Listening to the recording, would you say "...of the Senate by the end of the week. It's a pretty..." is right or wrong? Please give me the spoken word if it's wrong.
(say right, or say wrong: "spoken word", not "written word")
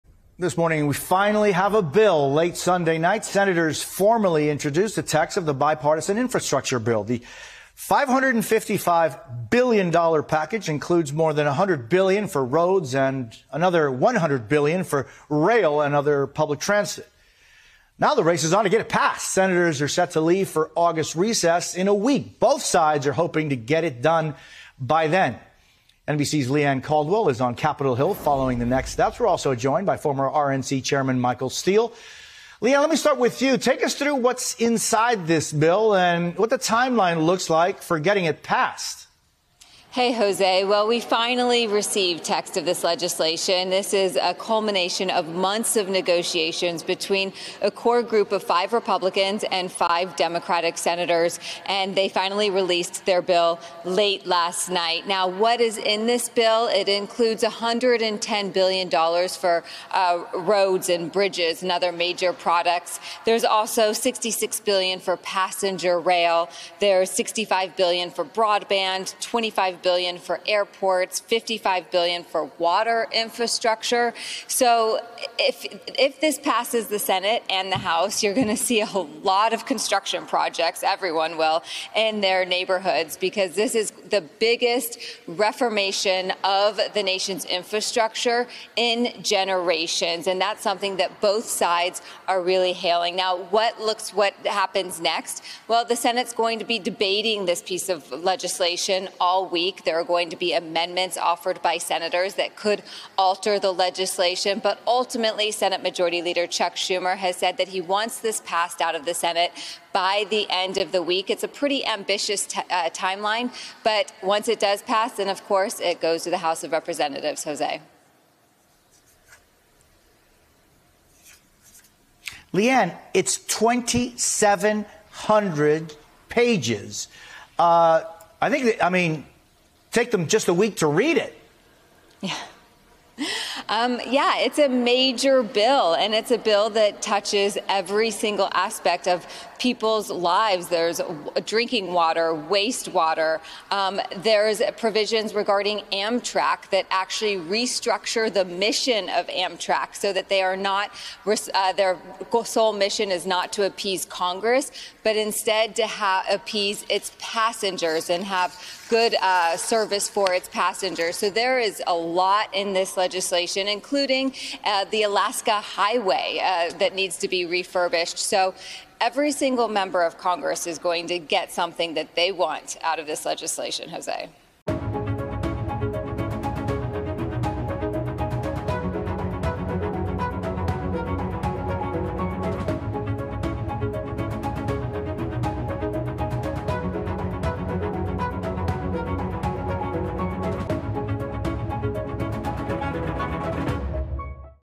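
right.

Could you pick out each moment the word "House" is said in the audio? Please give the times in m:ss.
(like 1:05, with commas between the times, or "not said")
1:17, 1:56.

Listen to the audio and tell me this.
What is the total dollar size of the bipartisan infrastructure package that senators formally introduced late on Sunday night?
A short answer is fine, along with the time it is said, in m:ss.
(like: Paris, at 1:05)
$555 billion, at 0:07.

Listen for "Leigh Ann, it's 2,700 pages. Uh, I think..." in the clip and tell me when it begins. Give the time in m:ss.
2:02.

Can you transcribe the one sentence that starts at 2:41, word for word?
So there is a lot in this legislation, including uh, the Alaska Highway uh, that needs to be refurbished.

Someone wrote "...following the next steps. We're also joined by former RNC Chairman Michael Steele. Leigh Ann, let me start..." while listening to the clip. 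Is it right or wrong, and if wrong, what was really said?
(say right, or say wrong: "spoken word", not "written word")
right.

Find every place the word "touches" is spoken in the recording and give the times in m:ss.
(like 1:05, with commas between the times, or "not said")
2:17.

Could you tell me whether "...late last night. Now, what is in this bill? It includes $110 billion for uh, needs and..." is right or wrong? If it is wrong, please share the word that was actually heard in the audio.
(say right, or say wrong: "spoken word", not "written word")
wrong: "roads", not "needs".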